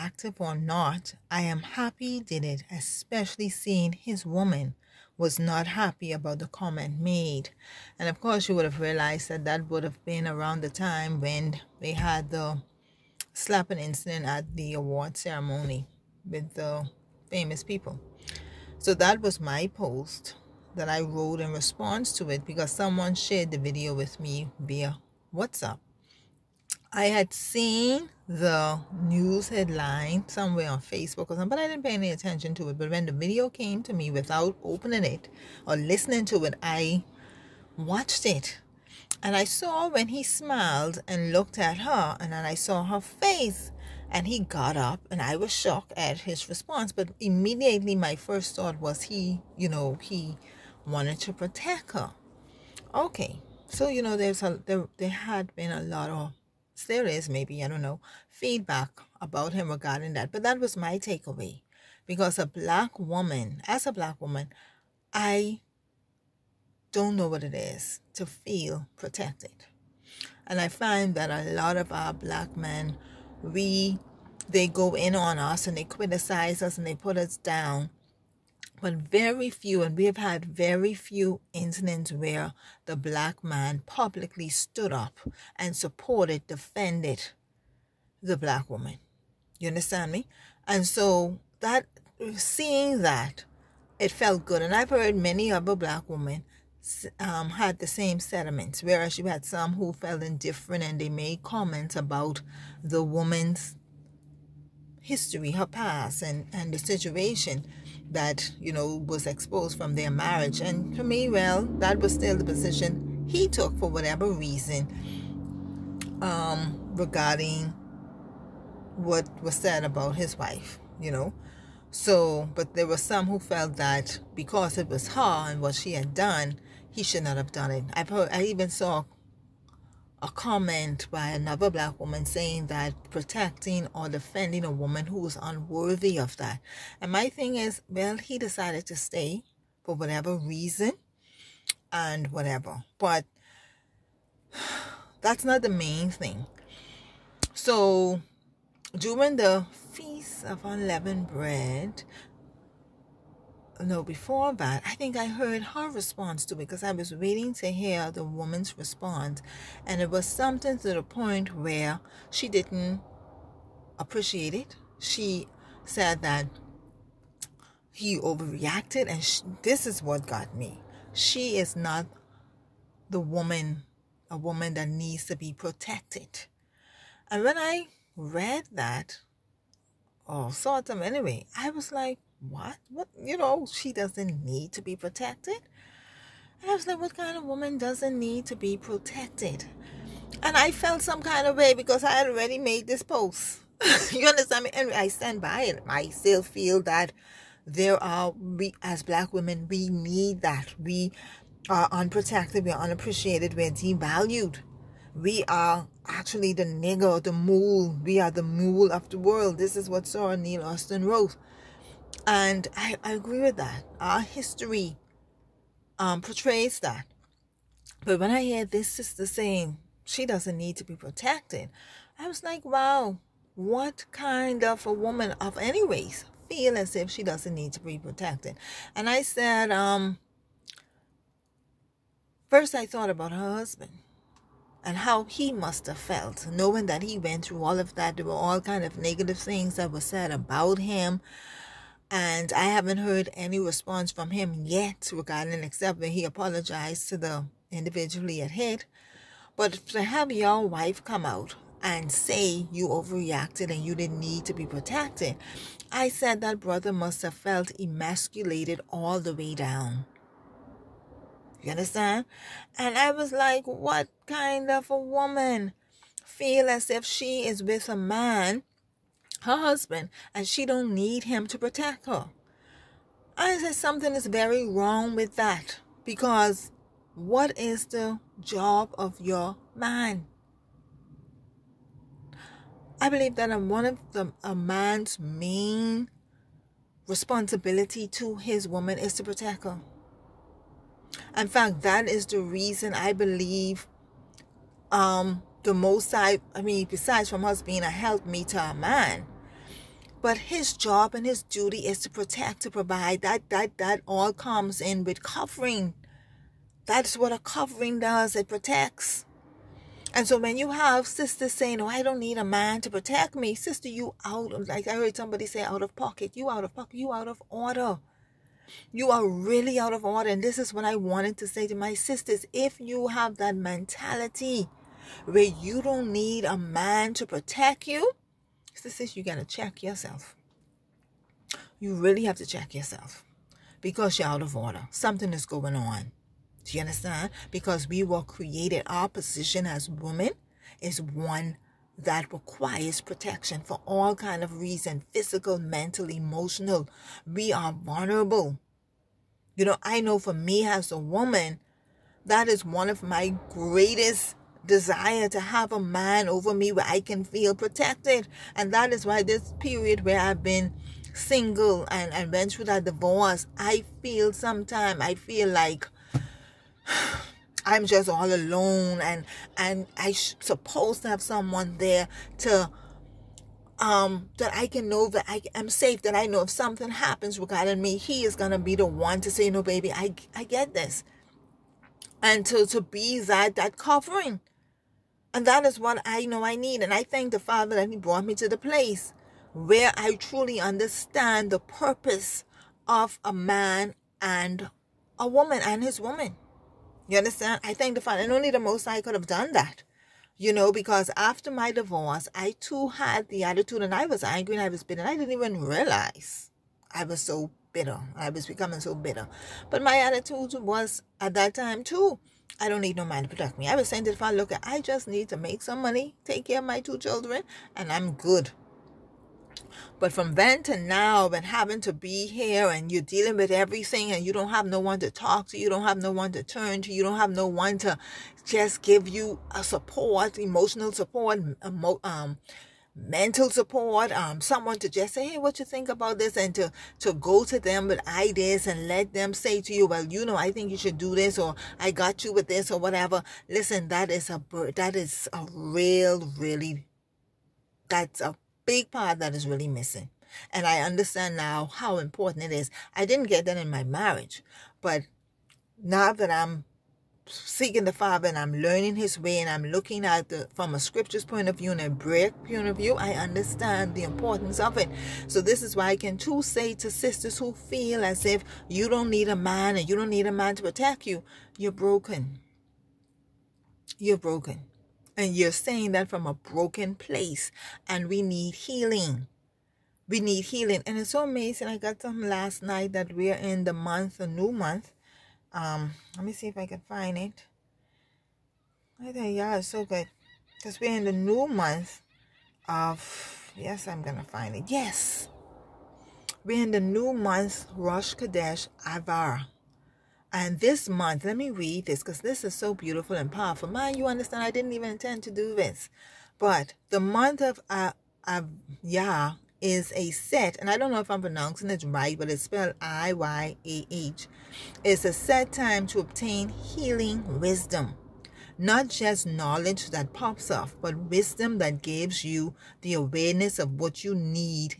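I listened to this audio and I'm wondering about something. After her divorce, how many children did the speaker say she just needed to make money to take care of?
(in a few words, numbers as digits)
2.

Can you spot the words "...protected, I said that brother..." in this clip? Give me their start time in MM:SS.
04:14.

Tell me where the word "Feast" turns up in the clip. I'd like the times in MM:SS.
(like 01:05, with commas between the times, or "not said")
02:29.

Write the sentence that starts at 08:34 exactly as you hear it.
It's a set time to obtain healing wisdom.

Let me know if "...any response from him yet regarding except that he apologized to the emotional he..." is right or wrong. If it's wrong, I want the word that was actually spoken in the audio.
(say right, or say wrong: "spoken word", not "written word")
wrong: "individual", not "emotional".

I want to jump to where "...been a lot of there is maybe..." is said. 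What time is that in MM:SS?
00:55.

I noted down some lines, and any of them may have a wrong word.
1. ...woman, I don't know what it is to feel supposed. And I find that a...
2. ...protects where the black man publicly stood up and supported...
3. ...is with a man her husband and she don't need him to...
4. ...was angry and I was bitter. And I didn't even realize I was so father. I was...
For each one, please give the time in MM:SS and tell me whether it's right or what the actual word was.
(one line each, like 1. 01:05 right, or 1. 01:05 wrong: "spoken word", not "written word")
1. 01:04 wrong: "protected", not "supposed"
2. 01:21 wrong: "incidents", not "protects"
3. 04:27 right
4. 06:44 wrong: "bitter", not "father".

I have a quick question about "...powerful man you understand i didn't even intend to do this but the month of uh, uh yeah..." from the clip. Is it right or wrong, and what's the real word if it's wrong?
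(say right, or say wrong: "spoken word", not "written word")
right.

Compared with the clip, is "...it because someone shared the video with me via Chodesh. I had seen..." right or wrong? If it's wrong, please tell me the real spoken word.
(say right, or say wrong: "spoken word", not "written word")
wrong: "WhatsApp", not "Chodesh".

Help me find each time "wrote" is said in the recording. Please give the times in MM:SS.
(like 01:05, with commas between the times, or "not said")
00:21, 03:31.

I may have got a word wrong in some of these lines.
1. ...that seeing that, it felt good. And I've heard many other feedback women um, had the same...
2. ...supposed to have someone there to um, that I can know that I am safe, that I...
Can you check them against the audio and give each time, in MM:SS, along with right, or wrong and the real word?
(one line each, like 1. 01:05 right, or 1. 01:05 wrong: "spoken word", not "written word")
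1. 01:31 wrong: "black", not "feedback"
2. 06:10 right.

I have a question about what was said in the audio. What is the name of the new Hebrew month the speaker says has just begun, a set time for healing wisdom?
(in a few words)
Iyar.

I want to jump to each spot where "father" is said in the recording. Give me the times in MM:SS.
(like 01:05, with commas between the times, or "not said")
06:27, 06:37, 06:54, 07:37.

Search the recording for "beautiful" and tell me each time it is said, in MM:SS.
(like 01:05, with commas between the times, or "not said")
08:22.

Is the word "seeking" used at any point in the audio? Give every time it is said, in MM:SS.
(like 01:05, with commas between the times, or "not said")
07:37.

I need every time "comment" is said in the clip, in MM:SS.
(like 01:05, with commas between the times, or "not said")
00:06, 01:41, 02:10.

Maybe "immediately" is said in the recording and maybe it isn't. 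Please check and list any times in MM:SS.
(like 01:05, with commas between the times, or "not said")
00:47.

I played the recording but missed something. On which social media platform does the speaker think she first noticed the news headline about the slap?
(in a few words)
Facebook.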